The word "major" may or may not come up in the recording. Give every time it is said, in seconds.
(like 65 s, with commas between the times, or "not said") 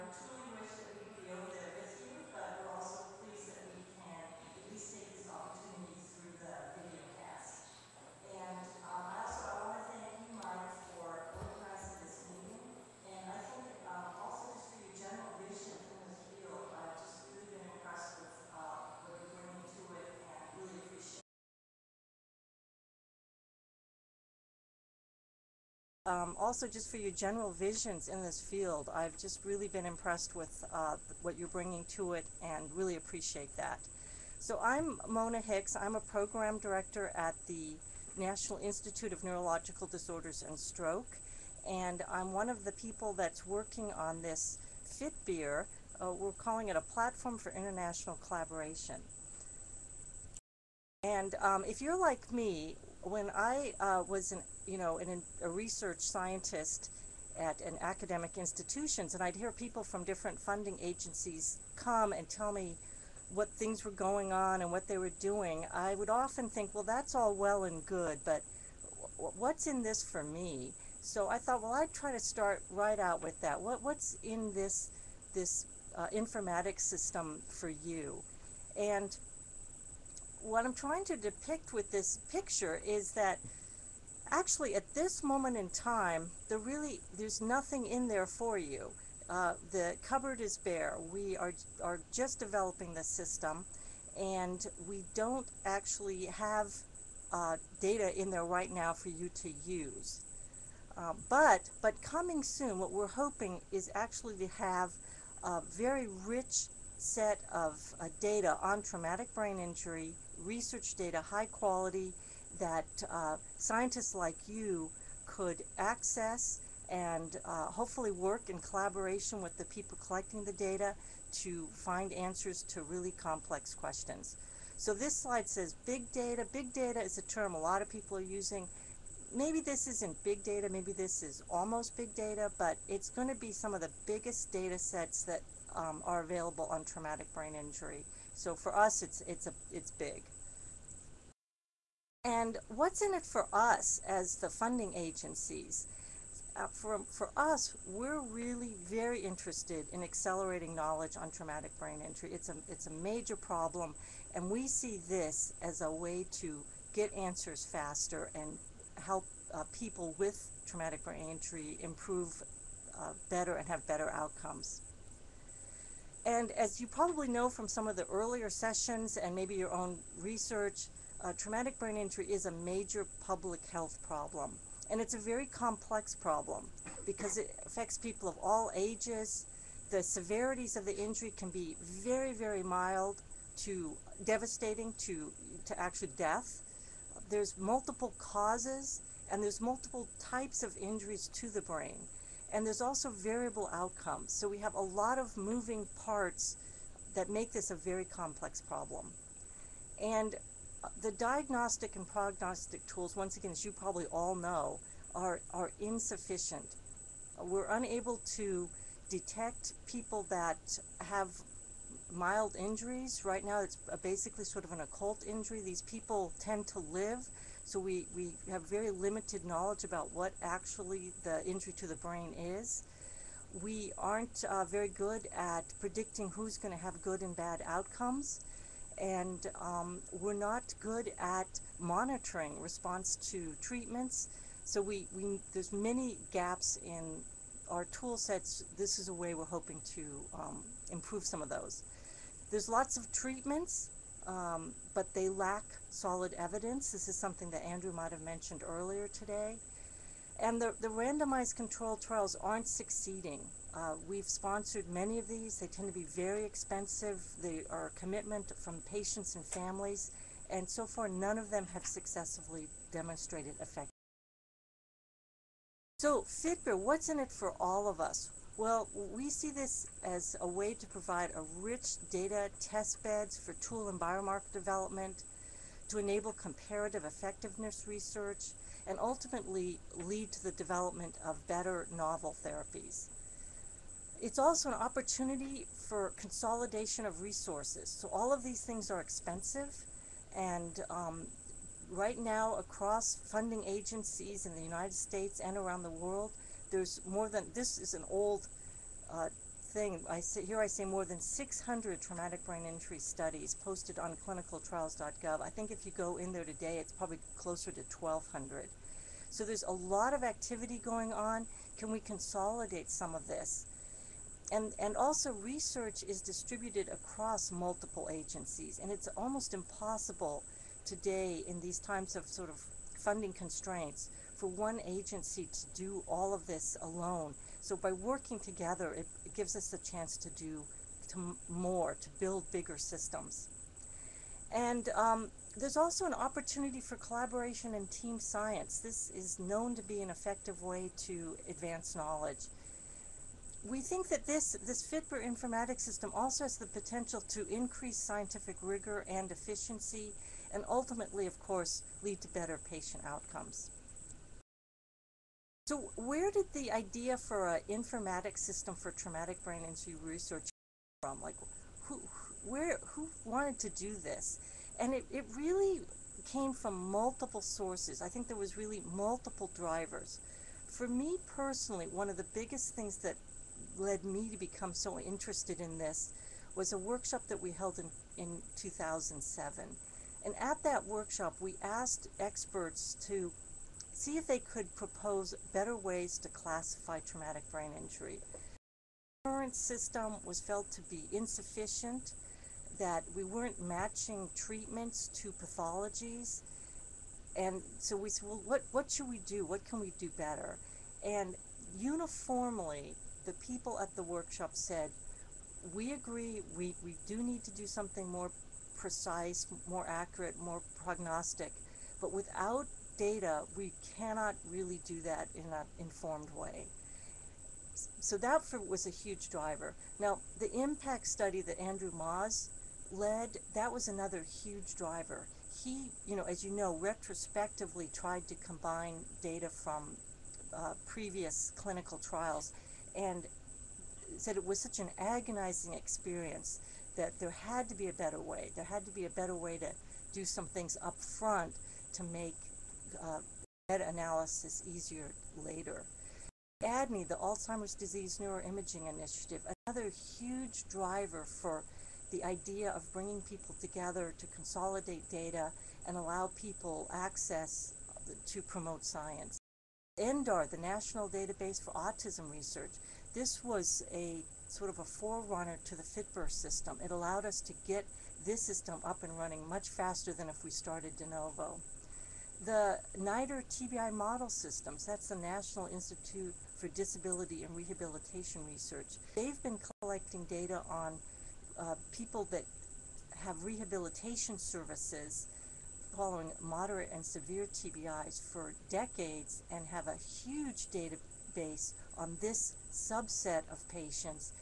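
152 s, 172 s.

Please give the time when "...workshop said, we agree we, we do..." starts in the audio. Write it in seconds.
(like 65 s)
404 s.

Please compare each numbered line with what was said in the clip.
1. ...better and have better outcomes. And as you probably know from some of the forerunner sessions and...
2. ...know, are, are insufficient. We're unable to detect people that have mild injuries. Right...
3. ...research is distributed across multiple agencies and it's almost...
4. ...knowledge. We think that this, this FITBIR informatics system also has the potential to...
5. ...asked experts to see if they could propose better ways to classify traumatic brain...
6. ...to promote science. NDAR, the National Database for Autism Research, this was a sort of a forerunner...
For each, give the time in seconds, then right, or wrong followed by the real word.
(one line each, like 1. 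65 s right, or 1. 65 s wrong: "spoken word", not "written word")
1. 163 s wrong: "earlier", not "forerunner"
2. 204 s right
3. 315 s right
4. 341 s right
5. 381 s right
6. 458 s right.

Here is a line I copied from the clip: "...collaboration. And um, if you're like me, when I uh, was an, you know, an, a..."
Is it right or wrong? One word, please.
right.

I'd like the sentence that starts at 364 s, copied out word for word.
And it, it really came from multiple sources.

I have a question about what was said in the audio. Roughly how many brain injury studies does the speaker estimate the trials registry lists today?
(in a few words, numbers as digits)
1,200.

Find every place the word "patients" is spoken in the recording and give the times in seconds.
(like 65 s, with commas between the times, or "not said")
258 s, 352 s, 493 s.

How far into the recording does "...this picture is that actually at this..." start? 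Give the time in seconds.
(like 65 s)
81 s.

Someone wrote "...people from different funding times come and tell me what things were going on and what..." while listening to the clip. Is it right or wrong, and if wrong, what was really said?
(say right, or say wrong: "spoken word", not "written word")
wrong: "agencies", not "times".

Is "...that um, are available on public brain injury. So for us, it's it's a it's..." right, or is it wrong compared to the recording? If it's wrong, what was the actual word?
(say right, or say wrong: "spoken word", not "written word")
wrong: "traumatic", not "public".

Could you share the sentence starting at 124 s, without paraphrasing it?
So this slide says big data.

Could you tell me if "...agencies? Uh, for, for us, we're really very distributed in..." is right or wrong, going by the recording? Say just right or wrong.
wrong.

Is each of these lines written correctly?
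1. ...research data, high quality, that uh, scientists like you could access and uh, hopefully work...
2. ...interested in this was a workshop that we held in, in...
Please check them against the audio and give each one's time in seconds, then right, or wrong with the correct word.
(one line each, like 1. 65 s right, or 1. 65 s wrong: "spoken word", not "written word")
1. 110 s right
2. 374 s right.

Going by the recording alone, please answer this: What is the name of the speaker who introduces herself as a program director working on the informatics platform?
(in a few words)
Mona Hicks.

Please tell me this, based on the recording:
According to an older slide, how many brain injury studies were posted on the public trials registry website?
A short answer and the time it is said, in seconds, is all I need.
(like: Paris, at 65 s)
more than 600, at 300 s.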